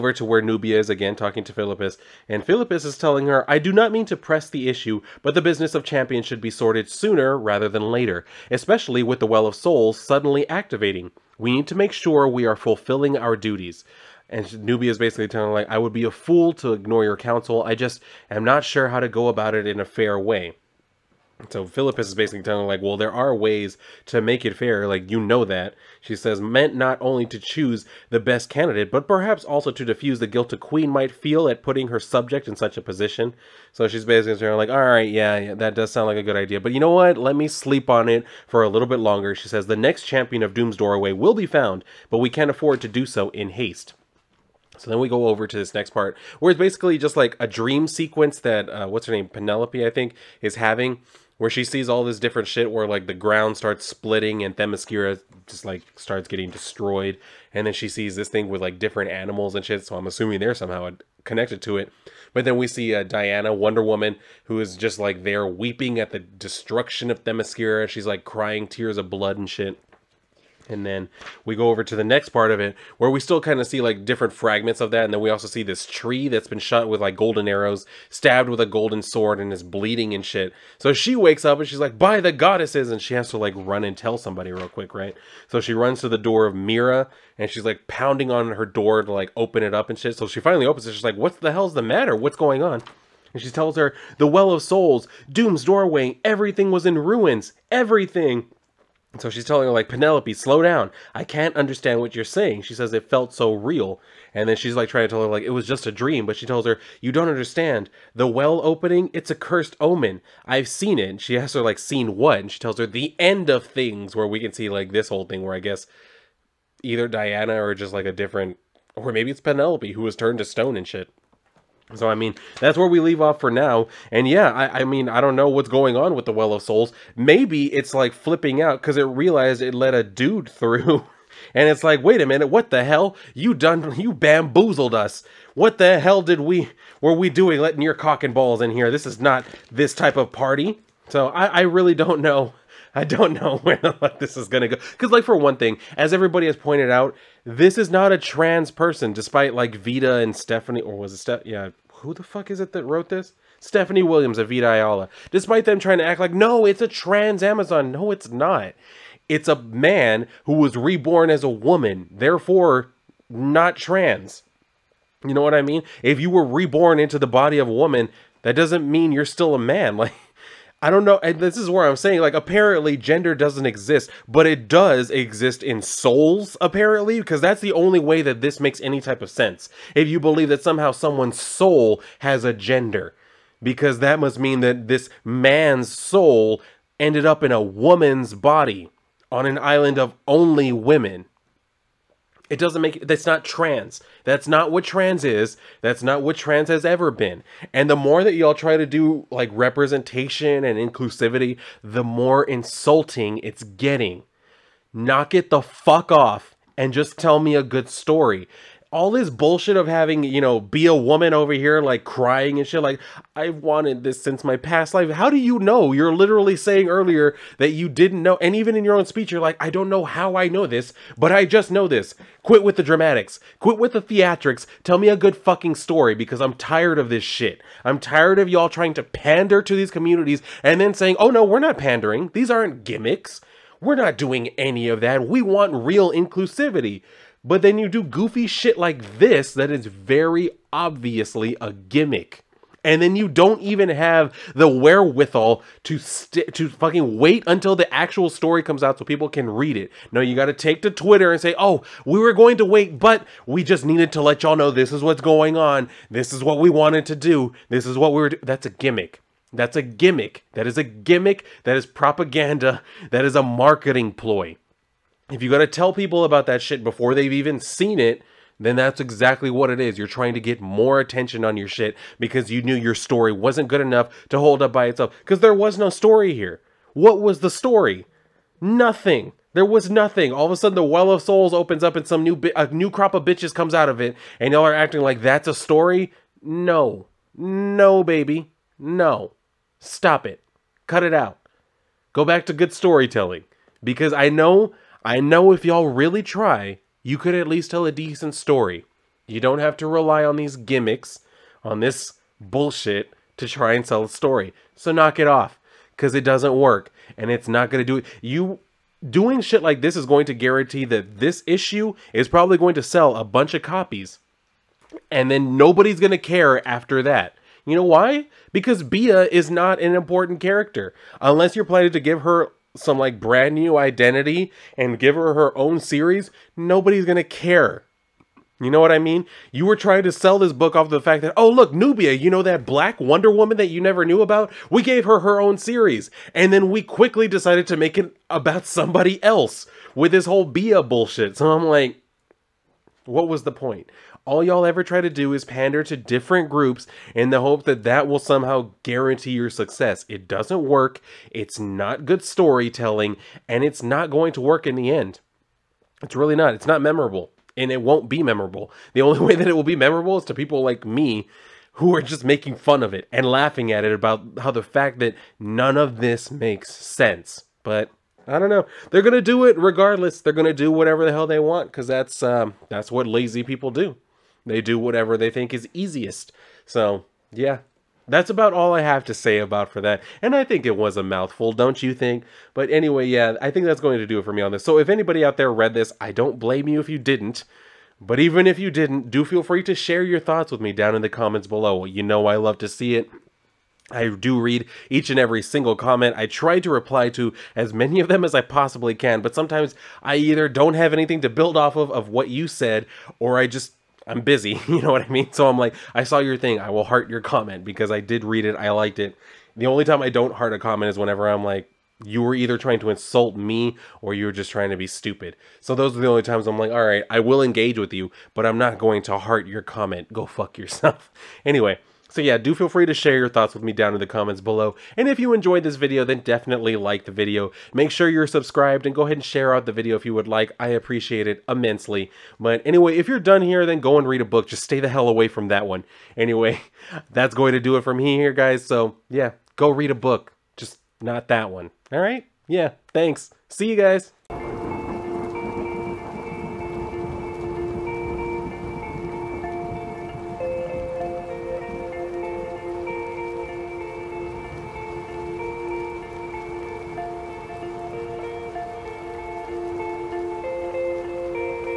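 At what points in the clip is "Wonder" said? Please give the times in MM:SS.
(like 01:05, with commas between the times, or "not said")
01:03, 05:33.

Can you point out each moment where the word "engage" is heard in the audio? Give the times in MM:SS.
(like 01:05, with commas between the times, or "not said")
06:57.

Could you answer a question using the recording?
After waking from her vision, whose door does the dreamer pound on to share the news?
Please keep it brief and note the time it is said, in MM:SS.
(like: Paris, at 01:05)
Mira, at 01:26.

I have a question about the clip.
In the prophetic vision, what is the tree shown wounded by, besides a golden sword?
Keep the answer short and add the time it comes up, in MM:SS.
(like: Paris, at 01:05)
Golden arrows, at 01:17.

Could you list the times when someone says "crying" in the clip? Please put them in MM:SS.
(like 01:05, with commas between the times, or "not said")
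01:08, 03:32.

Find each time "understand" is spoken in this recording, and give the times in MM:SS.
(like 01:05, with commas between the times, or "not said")
01:41, 01:47.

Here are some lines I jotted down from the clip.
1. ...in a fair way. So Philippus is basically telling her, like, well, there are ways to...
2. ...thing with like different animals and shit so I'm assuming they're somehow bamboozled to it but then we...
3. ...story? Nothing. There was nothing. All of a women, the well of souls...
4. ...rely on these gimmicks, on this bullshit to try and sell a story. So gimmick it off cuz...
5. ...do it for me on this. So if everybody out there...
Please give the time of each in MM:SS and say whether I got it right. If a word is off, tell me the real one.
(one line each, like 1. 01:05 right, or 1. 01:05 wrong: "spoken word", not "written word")
1. 00:19 right
2. 00:58 wrong: "connected", not "bamboozled"
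3. 04:37 wrong: "sudden", not "women"
4. 04:59 wrong: "knock", not "gimmick"
5. 06:24 wrong: "anybody", not "everybody".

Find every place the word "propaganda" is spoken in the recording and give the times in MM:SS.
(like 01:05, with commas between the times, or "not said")
04:21.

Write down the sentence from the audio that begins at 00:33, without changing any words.
So she's basically saying, like, all right, yeah, yeah, that does sound like a good idea.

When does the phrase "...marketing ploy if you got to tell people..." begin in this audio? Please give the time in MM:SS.
04:23.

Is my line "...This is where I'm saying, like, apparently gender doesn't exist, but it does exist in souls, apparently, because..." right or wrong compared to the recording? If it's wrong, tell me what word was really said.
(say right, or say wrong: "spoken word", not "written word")
right.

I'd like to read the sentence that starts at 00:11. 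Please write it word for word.
We need to make sure we are fulfilling our duties.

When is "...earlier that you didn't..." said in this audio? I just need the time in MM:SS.
03:36.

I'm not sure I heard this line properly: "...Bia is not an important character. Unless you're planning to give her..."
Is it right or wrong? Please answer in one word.
right.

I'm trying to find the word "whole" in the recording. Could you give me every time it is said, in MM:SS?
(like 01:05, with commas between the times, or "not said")
01:55, 05:40.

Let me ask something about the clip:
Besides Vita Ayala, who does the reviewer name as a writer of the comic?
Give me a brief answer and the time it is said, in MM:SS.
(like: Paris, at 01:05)
Stephanie Williams, at 02:33.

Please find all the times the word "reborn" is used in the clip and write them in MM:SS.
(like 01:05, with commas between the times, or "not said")
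02:40, 02:46.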